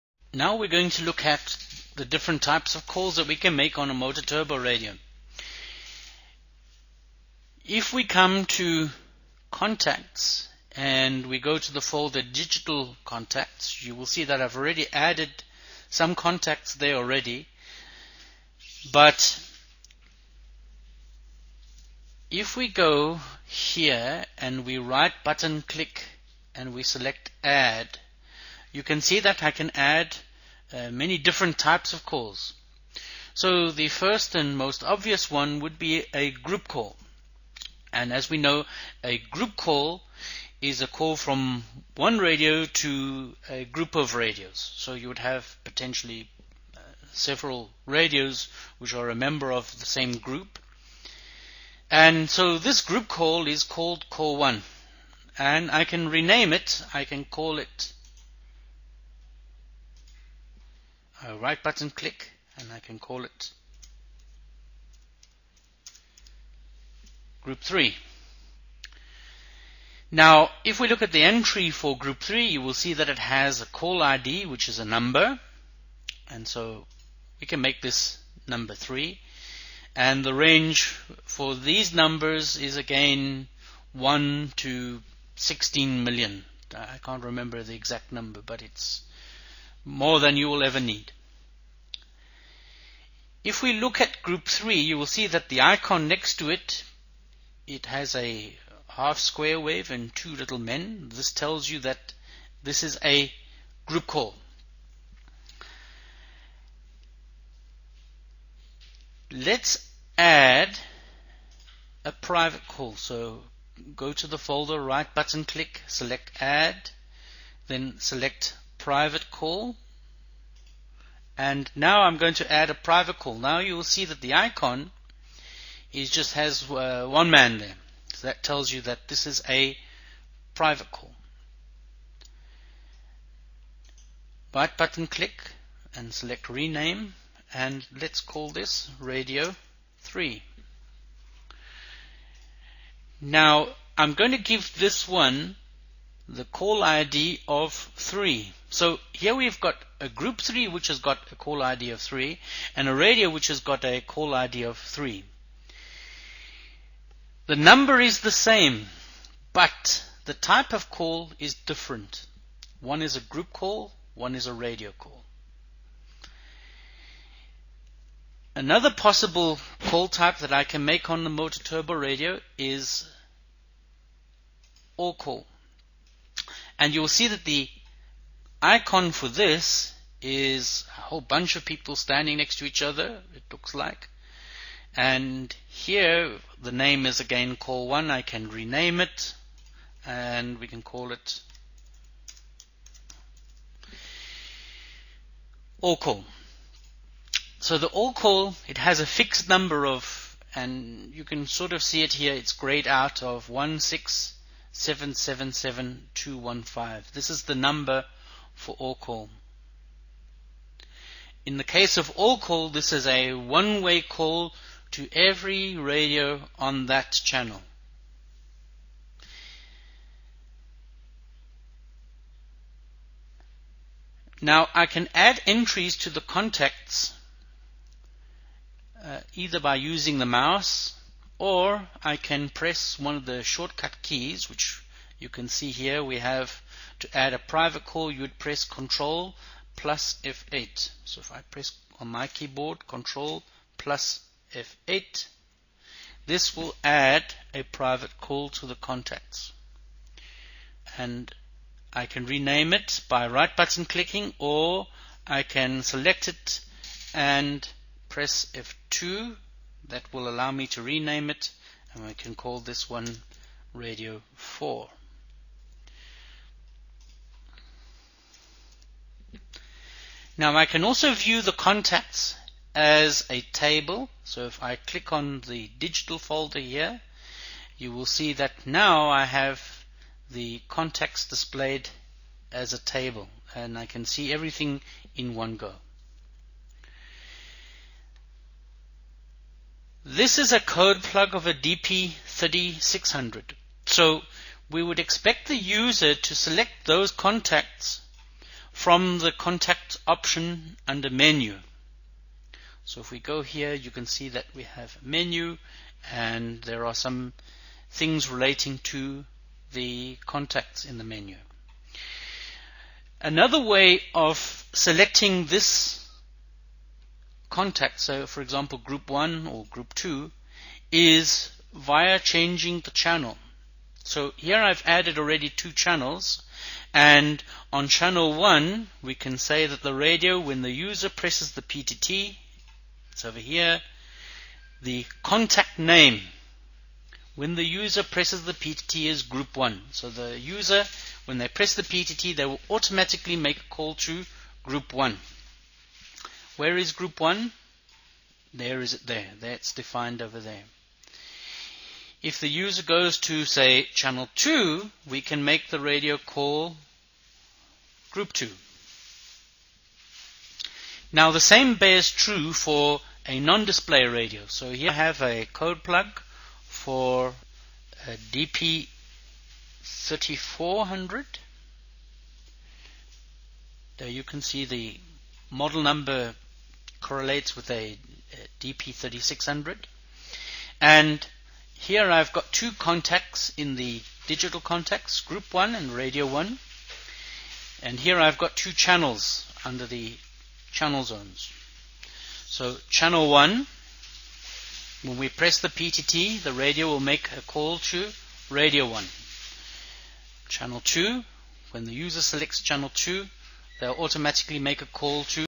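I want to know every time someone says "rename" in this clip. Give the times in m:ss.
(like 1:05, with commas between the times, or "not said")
0:56, 2:16, 3:08, 4:12, 4:20.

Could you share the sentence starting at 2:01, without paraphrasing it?
And now I'm going to add a private call.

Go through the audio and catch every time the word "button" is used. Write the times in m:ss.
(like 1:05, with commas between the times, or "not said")
0:25, 1:01, 1:55, 2:14, 4:13.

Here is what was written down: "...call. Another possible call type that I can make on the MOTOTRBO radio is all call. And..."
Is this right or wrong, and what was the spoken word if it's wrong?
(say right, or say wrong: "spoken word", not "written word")
right.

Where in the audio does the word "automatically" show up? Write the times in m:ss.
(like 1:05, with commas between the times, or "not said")
5:42, 6:43.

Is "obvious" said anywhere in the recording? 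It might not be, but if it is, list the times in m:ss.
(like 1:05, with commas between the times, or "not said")
0:34.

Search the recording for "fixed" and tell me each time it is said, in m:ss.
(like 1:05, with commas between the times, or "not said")
3:19.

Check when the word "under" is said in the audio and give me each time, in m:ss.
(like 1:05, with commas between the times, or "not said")
5:00, 6:29.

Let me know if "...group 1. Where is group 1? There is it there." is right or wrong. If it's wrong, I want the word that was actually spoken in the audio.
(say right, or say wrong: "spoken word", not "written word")
right.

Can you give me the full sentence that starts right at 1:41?
This tells you that this is a group call.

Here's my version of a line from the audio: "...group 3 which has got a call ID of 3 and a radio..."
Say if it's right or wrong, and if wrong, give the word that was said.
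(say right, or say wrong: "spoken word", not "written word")
right.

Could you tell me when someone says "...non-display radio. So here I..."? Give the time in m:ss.
6:03.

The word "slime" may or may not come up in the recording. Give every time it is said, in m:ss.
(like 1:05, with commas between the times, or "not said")
not said.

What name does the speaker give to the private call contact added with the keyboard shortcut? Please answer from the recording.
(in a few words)
radio 4.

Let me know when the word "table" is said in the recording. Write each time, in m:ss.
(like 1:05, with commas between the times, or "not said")
4:33, 4:42.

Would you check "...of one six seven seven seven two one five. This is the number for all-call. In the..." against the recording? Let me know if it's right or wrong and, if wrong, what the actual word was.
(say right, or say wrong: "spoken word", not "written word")
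right.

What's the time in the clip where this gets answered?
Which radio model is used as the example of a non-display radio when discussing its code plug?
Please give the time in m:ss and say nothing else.
6:08.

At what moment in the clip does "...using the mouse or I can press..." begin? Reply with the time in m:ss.
3:49.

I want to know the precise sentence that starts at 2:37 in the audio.
The number is the same but the type of call is different.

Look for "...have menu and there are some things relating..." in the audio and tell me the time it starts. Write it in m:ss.
5:04.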